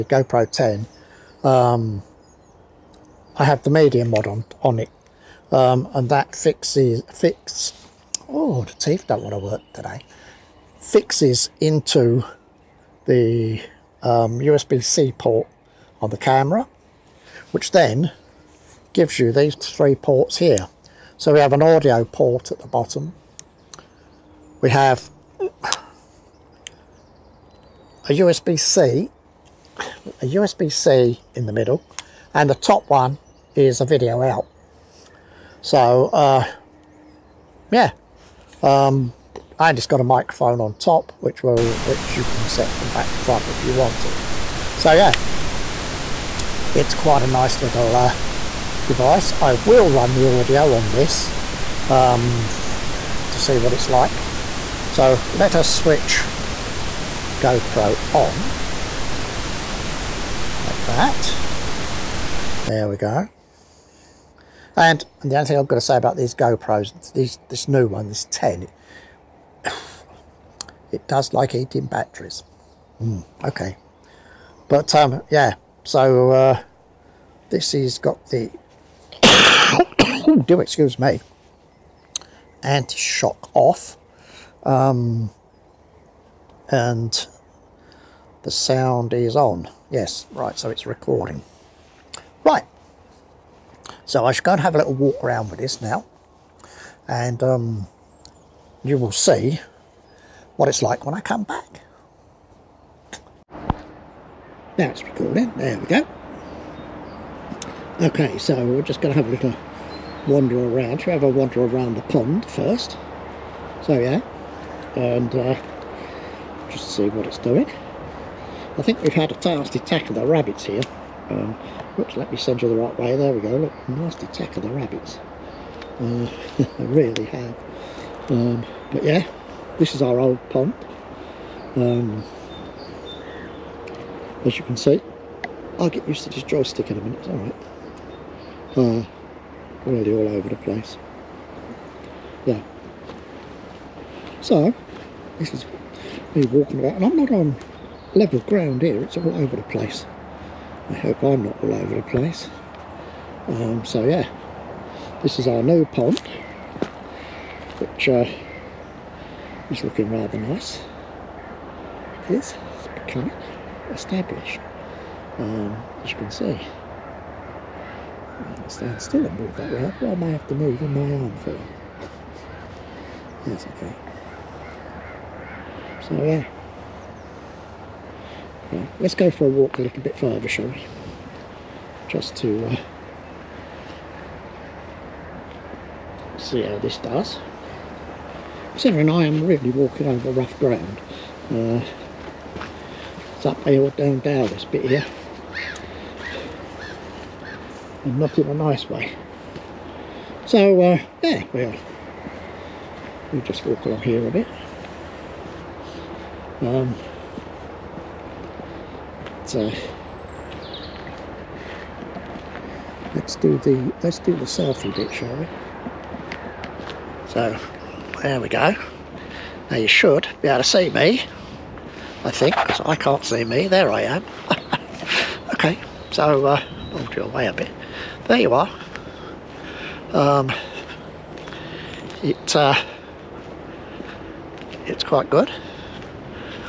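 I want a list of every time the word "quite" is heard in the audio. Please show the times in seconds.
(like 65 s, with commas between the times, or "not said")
46 s, 235 s.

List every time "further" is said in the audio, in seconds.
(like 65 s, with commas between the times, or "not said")
171 s, 180 s.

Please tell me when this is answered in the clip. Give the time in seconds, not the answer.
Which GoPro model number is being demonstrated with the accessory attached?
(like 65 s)
0 s.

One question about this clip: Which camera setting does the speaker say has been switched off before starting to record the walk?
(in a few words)
Anti-shock.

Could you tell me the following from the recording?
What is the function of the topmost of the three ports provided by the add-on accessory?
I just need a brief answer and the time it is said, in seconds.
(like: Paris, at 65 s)
Video out, at 33 s.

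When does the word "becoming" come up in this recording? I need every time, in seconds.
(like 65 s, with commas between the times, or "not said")
162 s.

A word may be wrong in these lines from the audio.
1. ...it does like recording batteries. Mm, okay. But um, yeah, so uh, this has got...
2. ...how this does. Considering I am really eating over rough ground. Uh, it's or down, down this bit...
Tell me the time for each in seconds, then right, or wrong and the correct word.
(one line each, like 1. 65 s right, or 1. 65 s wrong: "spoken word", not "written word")
1. 70 s wrong: "eating", not "recording"
2. 186 s wrong: "walking", not "eating".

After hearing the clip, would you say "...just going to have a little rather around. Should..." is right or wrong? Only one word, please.
wrong.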